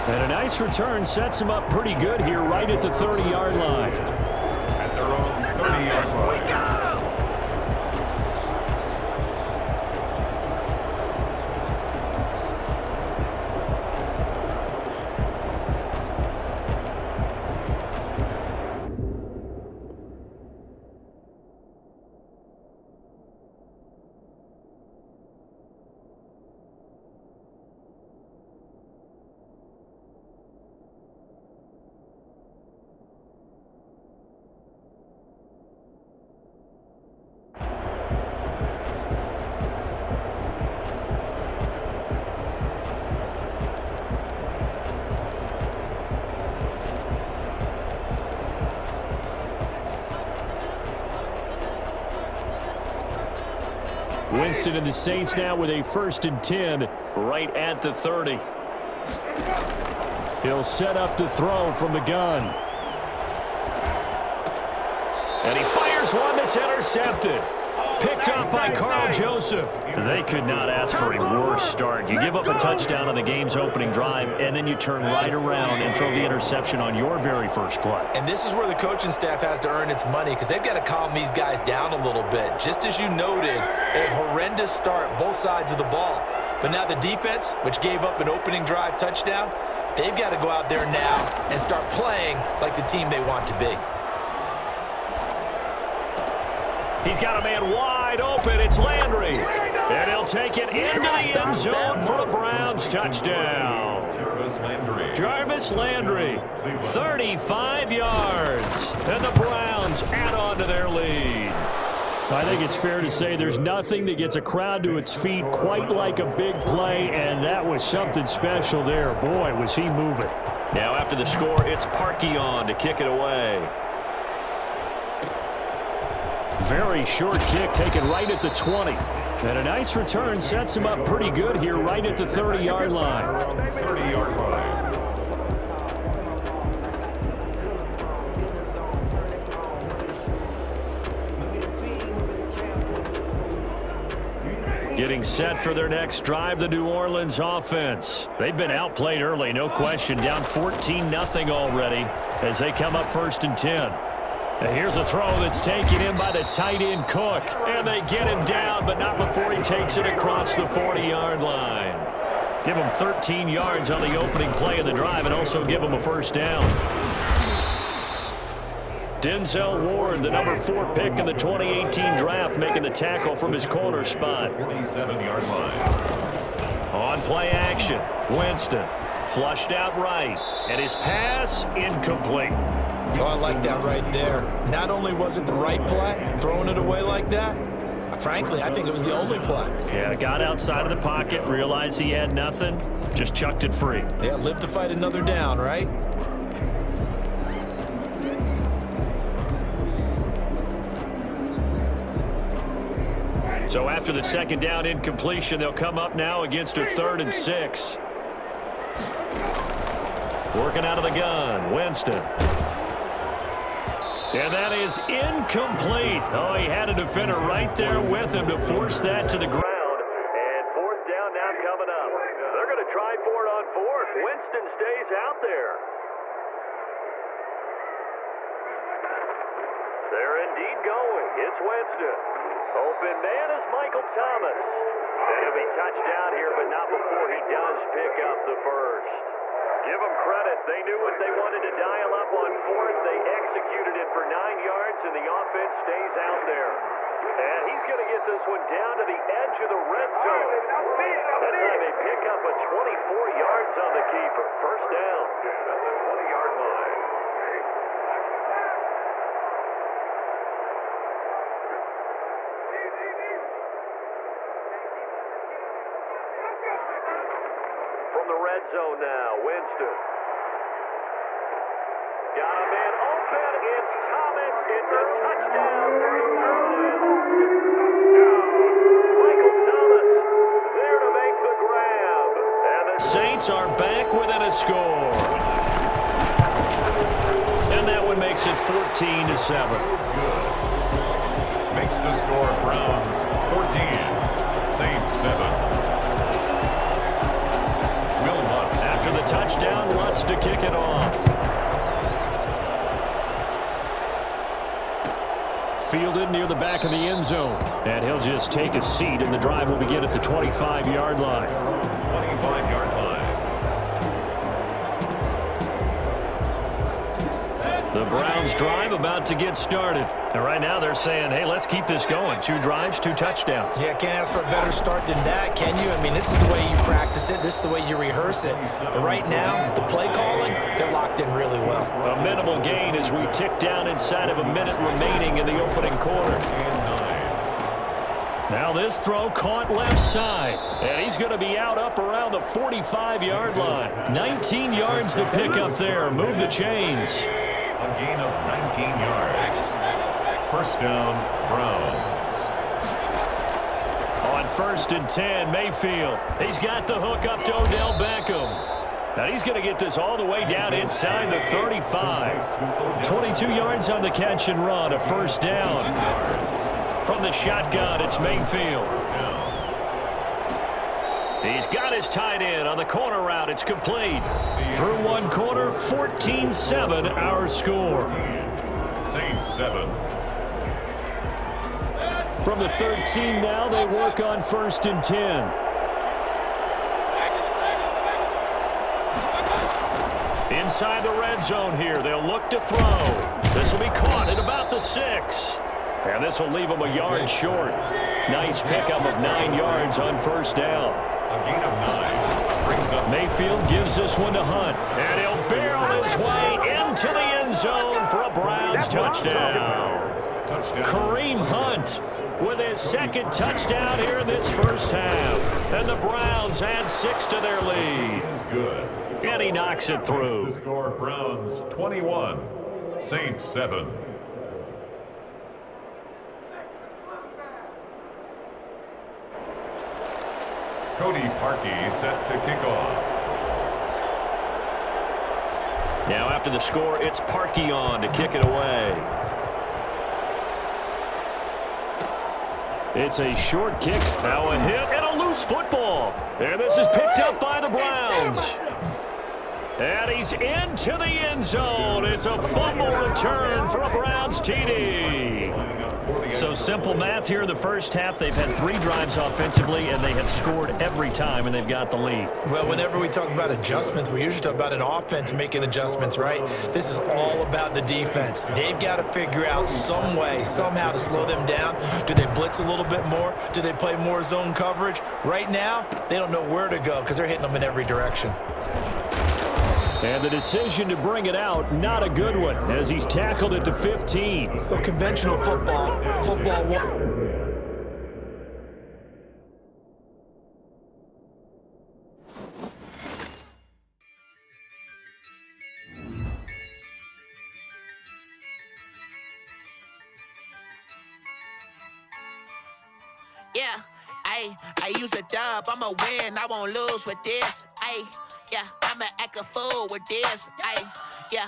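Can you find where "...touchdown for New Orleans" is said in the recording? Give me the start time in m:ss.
4:35.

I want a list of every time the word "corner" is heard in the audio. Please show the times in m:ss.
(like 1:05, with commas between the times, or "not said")
2:53, 6:12.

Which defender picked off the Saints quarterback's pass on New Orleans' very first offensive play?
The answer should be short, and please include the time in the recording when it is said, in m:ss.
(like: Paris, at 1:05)
Karl Joseph, at 1:08.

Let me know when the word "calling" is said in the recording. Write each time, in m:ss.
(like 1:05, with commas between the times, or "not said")
5:30.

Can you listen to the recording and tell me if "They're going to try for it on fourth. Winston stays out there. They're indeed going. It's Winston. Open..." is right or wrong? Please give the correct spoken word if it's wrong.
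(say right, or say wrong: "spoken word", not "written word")
right.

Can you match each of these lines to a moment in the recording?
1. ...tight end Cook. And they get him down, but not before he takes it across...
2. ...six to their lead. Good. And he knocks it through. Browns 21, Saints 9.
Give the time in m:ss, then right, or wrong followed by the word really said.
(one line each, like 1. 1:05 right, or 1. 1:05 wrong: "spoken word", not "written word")
1. 2:36 right
2. 6:56 wrong: "7", not "9".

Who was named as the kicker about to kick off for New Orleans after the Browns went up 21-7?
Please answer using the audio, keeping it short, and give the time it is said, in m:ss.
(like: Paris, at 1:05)
Cody Parkey, at 7:10.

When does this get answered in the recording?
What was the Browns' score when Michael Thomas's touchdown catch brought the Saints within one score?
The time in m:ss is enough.
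4:48.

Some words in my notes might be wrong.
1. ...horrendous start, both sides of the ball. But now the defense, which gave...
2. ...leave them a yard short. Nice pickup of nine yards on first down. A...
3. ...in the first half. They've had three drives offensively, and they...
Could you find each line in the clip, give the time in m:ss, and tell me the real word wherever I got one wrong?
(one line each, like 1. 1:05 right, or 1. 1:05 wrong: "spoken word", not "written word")
1. 1:24 right
2. 6:36 right
3. 7:37 right.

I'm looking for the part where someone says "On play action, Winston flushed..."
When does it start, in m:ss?
2:56.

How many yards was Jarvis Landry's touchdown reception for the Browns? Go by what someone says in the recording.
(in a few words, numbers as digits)
35.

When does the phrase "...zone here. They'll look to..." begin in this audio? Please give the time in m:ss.
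6:31.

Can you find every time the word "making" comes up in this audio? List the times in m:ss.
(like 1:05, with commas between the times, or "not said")
2:52, 7:45.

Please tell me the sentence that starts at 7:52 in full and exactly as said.
Do they blitz a little bit more?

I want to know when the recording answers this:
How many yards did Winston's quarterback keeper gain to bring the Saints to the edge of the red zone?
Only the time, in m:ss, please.
4:12.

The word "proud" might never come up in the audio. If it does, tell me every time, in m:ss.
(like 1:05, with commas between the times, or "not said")
not said.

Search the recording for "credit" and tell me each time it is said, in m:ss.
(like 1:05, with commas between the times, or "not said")
4:00.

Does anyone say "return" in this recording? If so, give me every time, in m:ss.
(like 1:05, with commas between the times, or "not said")
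0:00, 7:33.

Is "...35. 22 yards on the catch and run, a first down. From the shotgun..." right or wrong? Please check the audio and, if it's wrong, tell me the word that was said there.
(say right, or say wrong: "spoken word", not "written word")
right.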